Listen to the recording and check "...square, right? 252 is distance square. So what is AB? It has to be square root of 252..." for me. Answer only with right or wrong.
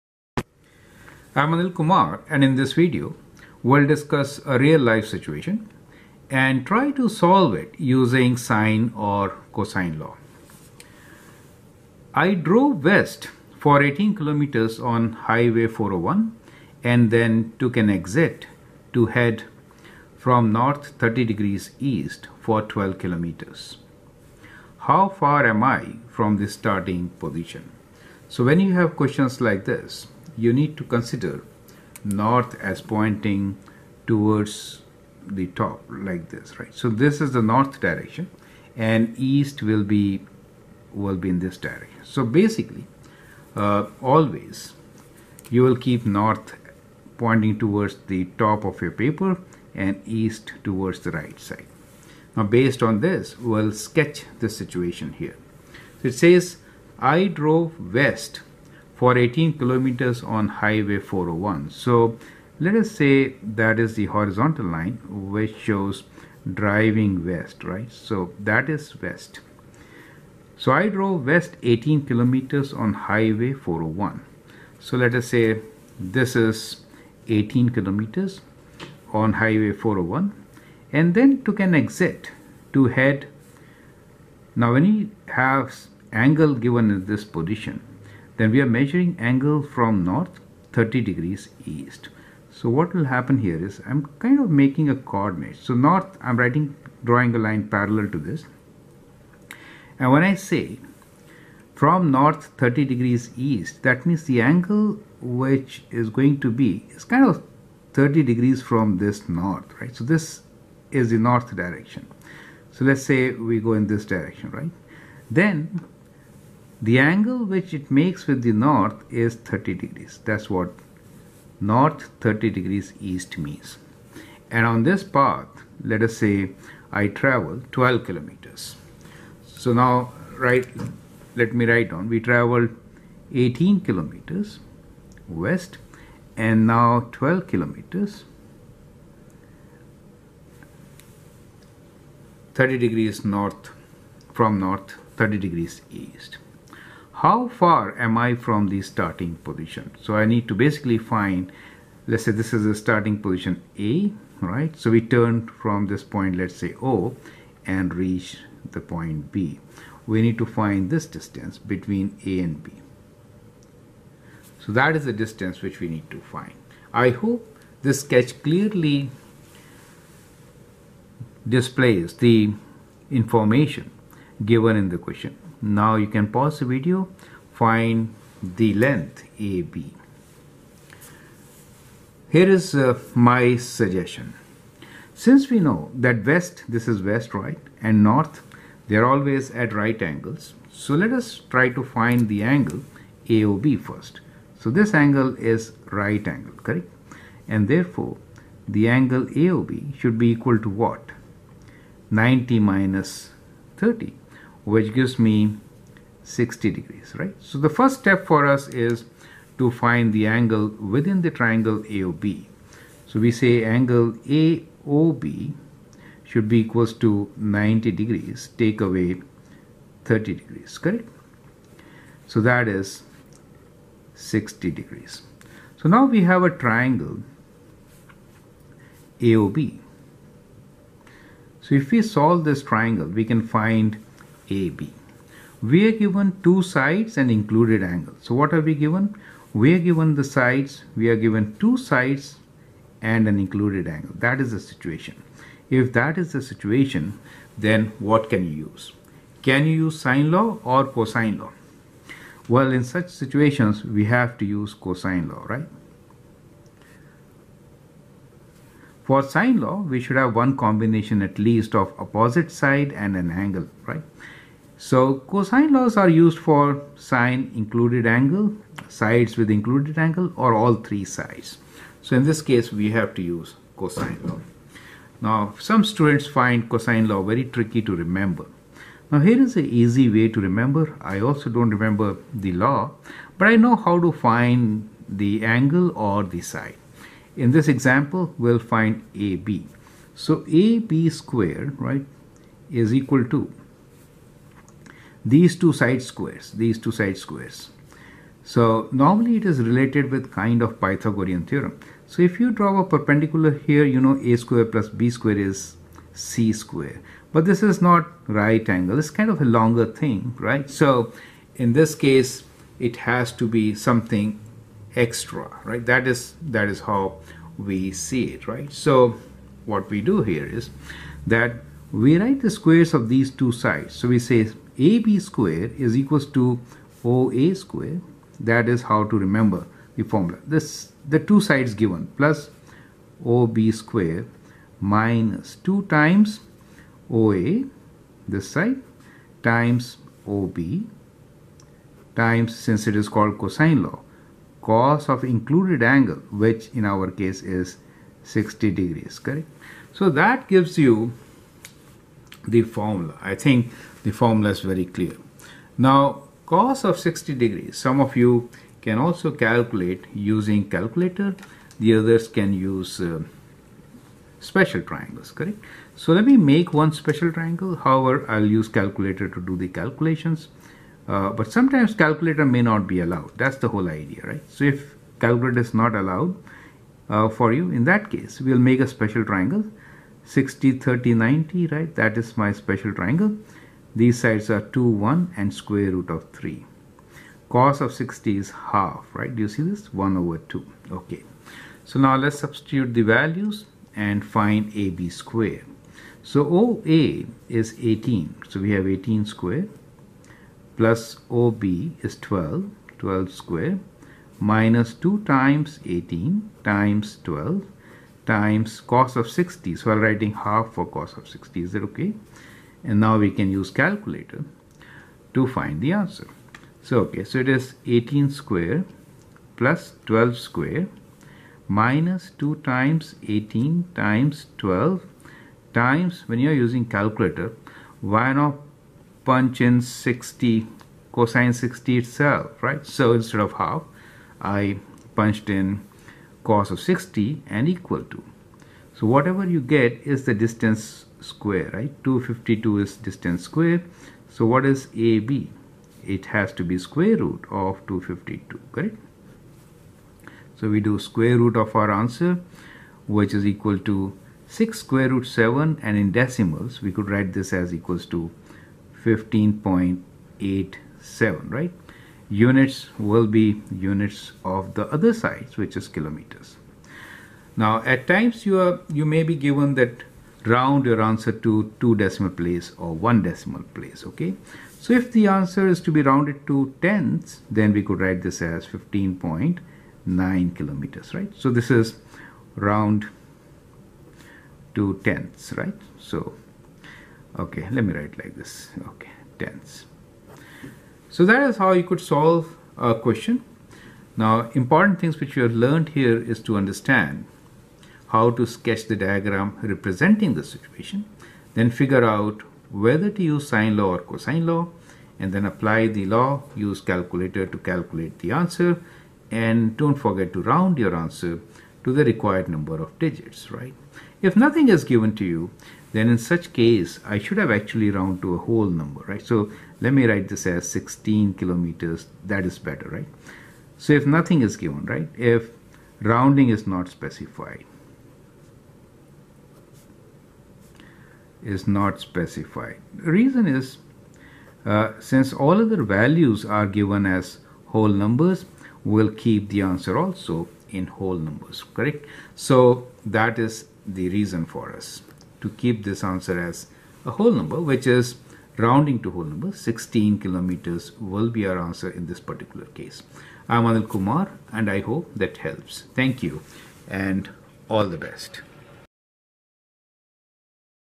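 right.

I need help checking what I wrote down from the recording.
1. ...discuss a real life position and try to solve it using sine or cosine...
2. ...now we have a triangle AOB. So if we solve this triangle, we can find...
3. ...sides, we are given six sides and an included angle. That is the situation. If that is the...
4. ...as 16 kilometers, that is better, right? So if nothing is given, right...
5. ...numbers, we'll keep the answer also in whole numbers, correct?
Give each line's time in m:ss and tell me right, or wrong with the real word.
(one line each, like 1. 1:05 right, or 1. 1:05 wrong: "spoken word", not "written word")
1. 0:03 wrong: "situation", not "position"
2. 3:45 right
3. 4:00 wrong: "two", not "six"
4. 8:40 right
5. 8:57 right.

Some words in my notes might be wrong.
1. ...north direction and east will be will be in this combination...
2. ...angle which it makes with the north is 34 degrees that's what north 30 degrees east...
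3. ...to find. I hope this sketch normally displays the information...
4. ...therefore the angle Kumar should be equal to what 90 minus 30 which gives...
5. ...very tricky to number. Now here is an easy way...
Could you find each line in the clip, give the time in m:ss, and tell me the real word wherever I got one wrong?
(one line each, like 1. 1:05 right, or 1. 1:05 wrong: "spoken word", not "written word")
1. 0:37 wrong: "direction", not "combination"
2. 1:56 wrong: "30", not "34"
3. 2:46 wrong: "clearly", not "normally"
4. 3:17 wrong: "AOB", not "Kumar"
5. 4:37 wrong: "remember", not "number".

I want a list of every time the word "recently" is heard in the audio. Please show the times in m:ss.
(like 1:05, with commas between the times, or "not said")
not said.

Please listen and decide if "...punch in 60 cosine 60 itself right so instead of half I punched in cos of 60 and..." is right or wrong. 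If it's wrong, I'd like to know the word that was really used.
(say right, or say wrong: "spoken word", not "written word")
right.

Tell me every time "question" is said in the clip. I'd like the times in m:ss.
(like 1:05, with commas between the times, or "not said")
0:28, 2:54, 8:12.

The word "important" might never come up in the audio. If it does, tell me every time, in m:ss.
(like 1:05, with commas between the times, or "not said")
8:14.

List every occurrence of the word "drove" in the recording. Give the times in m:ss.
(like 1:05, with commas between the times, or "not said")
0:12, 0:57, 1:10.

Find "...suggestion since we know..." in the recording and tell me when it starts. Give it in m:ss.
3:03.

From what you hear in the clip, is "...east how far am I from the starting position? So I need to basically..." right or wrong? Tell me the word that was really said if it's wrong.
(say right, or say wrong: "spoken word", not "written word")
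right.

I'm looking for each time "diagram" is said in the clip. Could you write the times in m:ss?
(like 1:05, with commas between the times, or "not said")
8:18.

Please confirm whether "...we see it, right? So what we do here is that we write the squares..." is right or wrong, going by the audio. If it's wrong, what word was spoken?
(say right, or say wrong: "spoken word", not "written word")
right.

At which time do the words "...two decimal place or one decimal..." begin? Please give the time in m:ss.
7:51.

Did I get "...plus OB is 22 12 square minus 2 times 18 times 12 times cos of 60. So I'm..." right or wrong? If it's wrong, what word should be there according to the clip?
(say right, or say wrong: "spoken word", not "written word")
wrong: "12", not "22".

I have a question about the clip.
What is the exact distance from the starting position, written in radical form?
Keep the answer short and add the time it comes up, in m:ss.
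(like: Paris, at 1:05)
6√7, at 7:34.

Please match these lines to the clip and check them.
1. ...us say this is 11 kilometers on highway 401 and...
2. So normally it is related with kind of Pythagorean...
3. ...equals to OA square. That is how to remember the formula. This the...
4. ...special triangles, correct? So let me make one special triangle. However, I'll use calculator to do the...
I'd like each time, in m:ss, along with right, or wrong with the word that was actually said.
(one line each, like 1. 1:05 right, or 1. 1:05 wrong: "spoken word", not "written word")
1. 1:15 wrong: "18", not "11"
2. 4:58 right
3. 5:25 right
4. 6:04 right.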